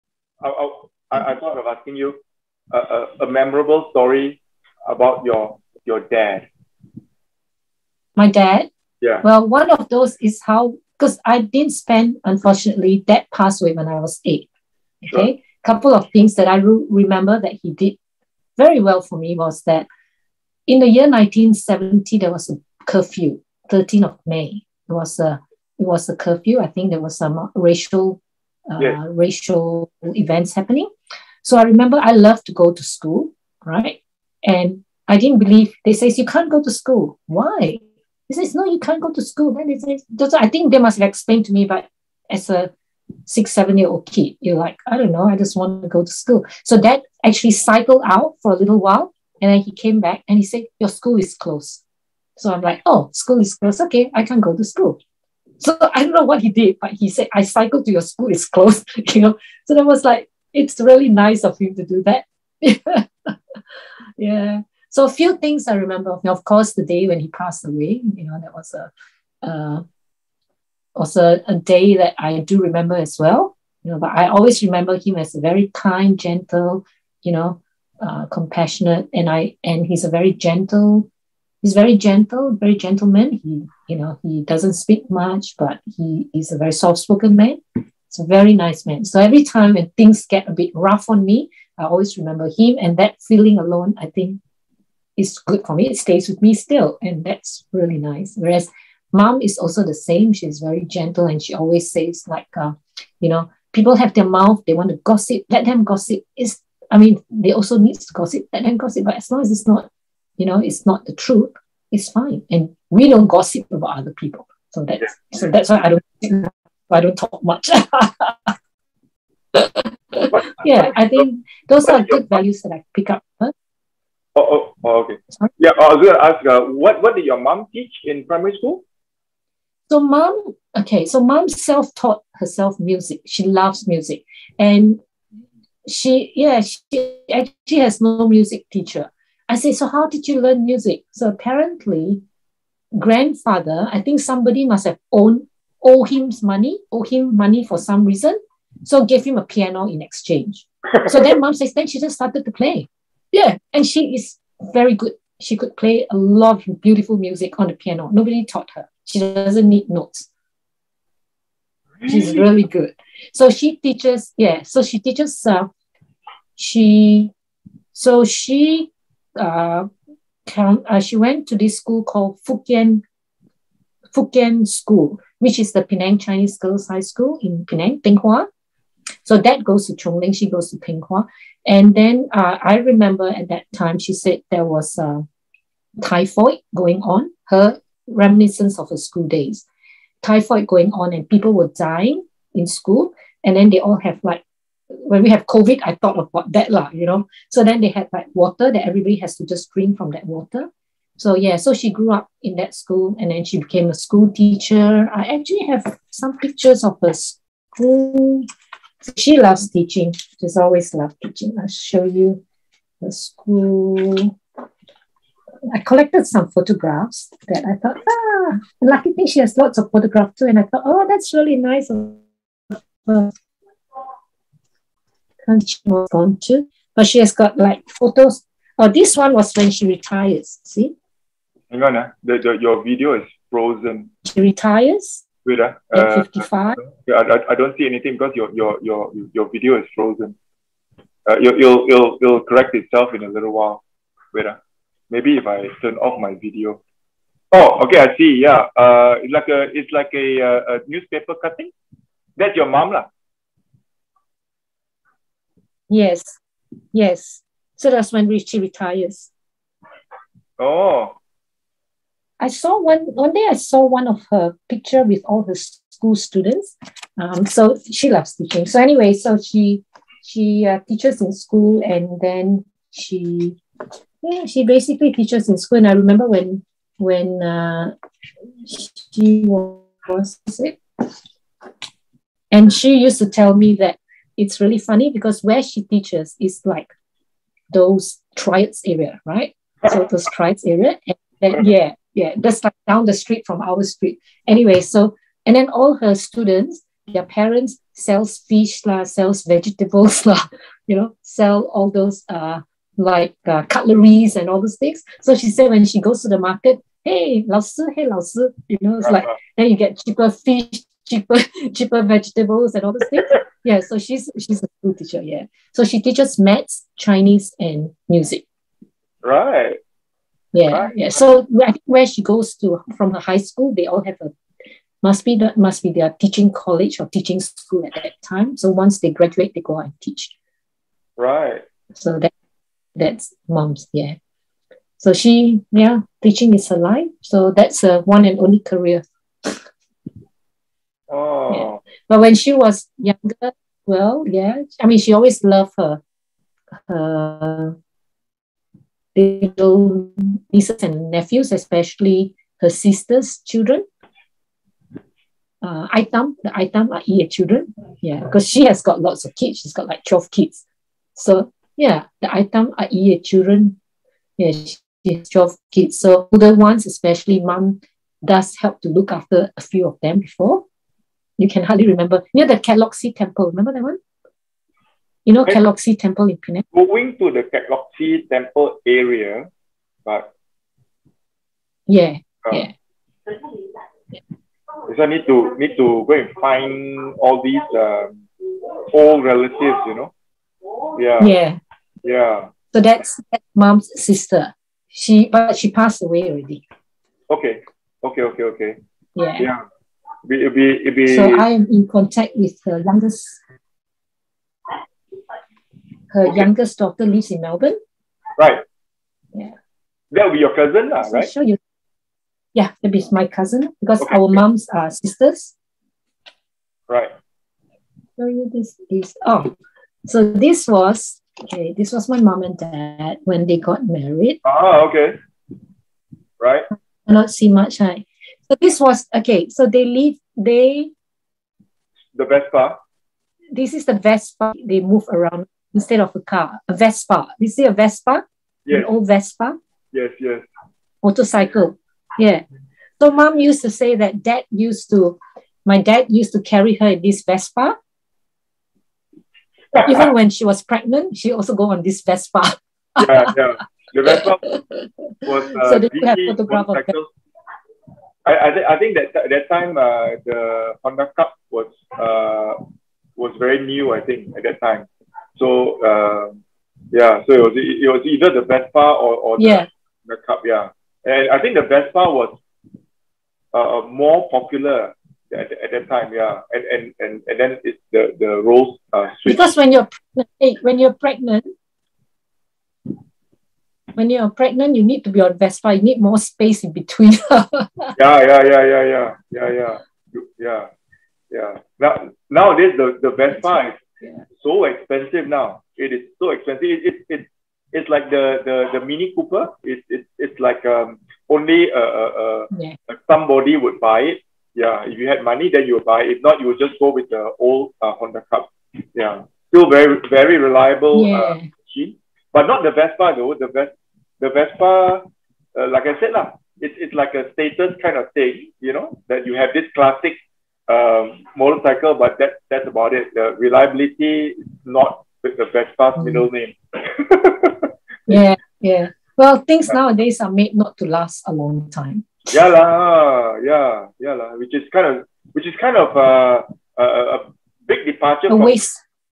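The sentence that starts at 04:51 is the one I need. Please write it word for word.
And then, yeah, yeah, that's like down the street from our street.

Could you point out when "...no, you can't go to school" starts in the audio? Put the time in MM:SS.
00:38.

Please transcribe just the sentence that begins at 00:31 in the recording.
So I remember I love to go to school, right?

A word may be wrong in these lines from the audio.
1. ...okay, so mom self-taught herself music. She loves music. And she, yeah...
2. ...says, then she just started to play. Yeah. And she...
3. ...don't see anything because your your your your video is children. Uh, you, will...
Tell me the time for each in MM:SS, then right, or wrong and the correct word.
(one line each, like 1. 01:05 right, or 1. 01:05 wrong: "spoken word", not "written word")
1. 02:10 right
2. 02:31 right
3. 03:57 wrong: "frozen", not "children".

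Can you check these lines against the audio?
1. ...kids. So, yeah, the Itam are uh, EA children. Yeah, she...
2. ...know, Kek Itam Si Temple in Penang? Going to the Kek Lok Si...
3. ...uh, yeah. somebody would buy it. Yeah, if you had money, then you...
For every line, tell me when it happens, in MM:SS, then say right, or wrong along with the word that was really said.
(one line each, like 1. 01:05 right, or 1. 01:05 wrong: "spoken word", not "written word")
1. 06:00 right
2. 06:15 wrong: "Lok", not "Itam"
3. 08:22 right.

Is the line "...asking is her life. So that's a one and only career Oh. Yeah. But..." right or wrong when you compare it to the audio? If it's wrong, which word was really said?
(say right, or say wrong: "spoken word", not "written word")
wrong: "teaching", not "asking".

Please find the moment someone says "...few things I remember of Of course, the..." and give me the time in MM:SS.
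01:05.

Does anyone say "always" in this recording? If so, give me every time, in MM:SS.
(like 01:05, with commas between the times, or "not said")
01:14, 01:31, 01:41, 03:30, 05:45.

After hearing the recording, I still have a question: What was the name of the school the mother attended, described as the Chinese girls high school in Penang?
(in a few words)
Fukien School.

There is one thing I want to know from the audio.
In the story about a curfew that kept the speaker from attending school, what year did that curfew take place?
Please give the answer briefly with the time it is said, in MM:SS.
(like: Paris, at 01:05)
1970, at 00:21.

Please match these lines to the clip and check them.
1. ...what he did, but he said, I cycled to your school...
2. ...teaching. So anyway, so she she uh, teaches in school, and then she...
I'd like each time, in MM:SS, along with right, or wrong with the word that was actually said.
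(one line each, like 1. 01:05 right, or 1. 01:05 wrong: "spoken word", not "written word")
1. 00:56 right
2. 04:28 right.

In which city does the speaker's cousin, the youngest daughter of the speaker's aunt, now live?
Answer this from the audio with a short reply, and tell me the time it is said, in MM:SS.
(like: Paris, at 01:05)
Melbourne, at 06:47.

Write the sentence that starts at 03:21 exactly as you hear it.
So yeah, so she grew up in that school and then she became a school teacher.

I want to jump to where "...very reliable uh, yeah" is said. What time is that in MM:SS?
08:30.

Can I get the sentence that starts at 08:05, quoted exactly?
You need more space in between.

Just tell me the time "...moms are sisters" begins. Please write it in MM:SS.
06:54.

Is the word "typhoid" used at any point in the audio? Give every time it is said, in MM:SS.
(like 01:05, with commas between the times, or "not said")
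03:06, 03:10.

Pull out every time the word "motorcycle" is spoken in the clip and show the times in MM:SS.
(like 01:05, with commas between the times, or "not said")
07:20, 08:41.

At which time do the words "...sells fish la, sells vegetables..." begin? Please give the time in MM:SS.
04:57.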